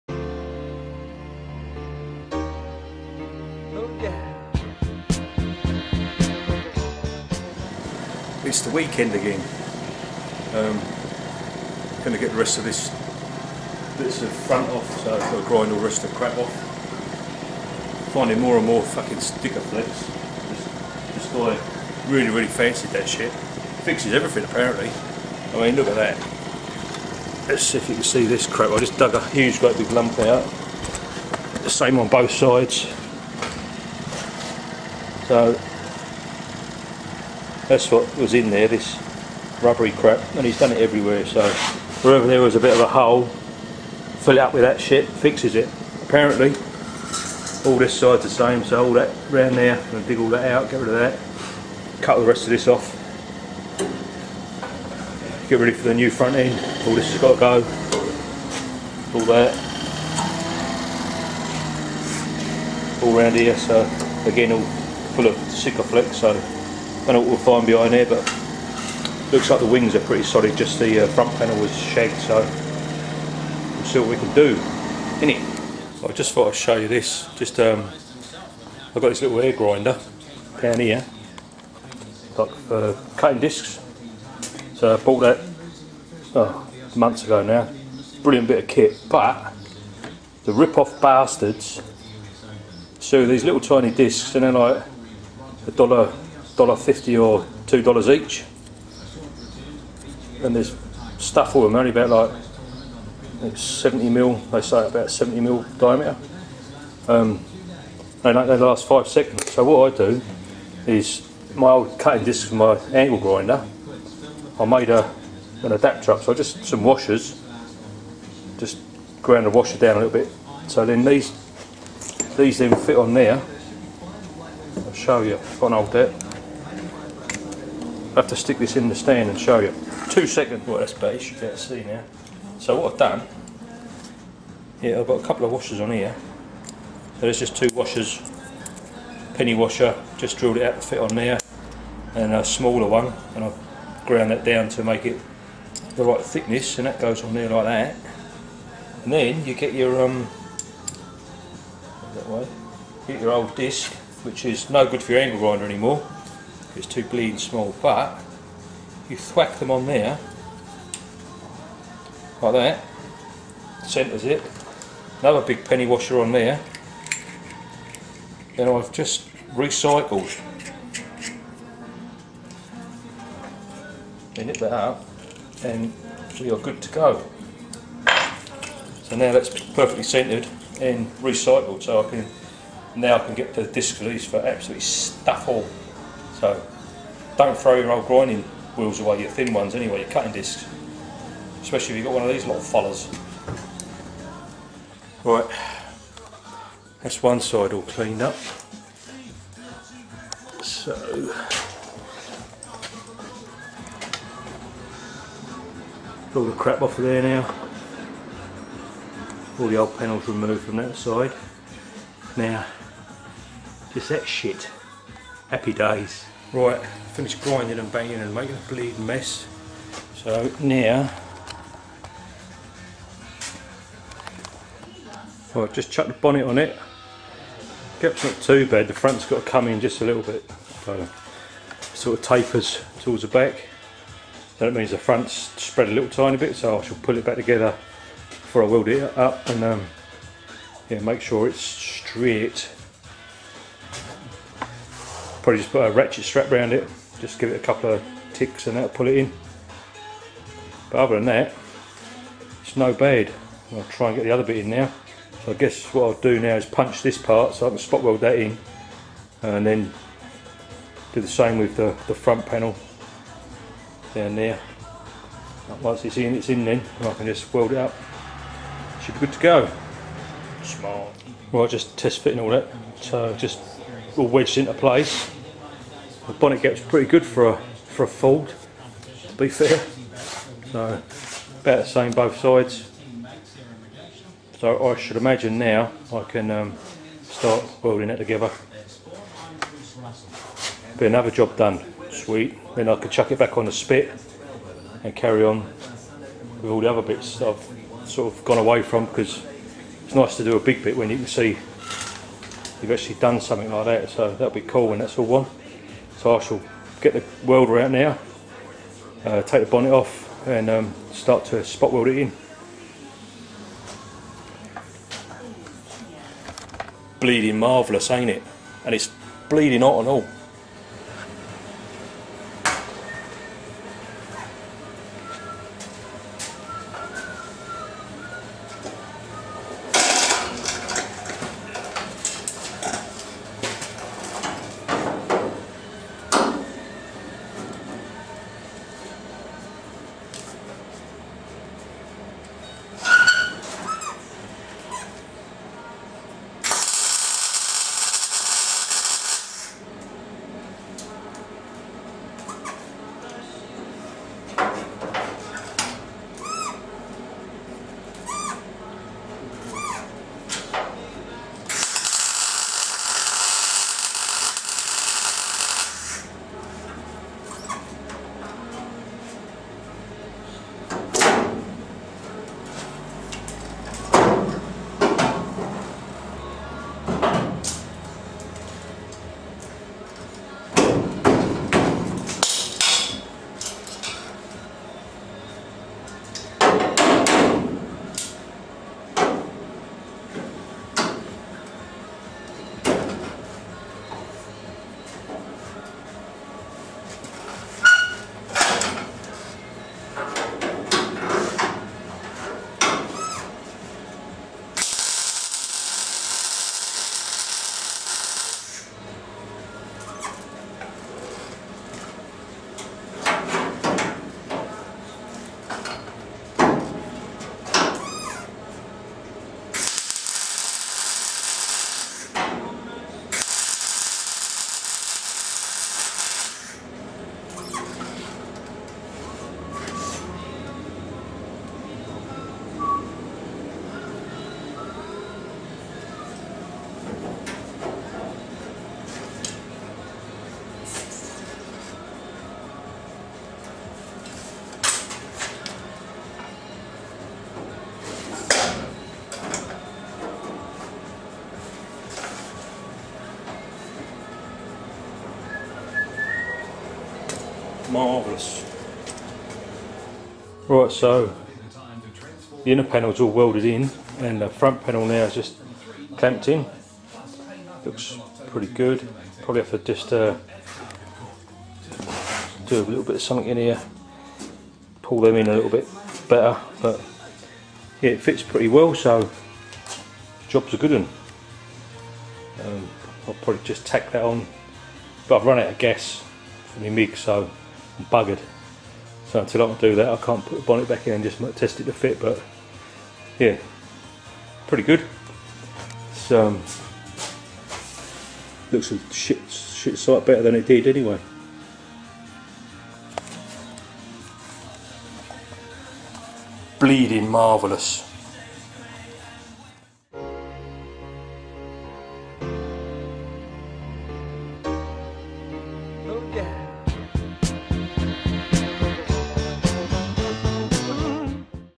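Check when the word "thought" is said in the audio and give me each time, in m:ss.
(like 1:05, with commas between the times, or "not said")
0:21, 1:16.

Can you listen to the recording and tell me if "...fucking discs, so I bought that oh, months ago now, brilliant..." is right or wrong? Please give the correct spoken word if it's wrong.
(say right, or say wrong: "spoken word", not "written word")
wrong: "cutting", not "fucking".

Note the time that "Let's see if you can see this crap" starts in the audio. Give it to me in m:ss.
0:27.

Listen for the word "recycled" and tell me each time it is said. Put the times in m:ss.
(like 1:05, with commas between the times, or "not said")
2:49, 3:01.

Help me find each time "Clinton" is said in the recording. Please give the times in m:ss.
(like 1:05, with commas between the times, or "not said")
not said.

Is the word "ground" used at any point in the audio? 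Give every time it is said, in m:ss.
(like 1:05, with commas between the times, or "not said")
1:59, 2:24.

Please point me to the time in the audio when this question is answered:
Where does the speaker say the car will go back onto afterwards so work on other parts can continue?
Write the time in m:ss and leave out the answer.
4:53.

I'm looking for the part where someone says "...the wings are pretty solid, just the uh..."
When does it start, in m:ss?
1:09.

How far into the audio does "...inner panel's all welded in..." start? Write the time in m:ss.
7:42.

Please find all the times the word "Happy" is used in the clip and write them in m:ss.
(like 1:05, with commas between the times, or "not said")
3:35.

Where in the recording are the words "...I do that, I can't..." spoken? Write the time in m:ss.
8:09.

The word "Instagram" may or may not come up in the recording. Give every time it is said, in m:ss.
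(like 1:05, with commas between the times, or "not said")
not said.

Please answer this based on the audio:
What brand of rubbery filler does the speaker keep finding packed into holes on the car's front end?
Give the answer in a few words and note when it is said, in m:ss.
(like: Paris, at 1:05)
Sikaflex, at 0:19.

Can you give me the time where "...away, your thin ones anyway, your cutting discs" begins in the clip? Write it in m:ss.
3:08.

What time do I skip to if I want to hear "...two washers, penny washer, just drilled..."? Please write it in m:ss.
2:17.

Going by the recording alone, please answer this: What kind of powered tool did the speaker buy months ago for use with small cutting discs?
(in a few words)
air grinder.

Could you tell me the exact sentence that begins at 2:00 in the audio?
So then these these then fit on there, show you.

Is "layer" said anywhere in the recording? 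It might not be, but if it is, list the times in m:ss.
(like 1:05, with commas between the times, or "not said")
not said.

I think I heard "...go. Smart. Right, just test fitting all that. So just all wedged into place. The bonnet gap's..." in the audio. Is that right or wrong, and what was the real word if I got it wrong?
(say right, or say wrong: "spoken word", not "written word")
right.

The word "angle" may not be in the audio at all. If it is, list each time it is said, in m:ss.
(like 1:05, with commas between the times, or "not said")
1:52, 2:35.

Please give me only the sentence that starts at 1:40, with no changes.
And there's stuff for them, only about like 70 mil.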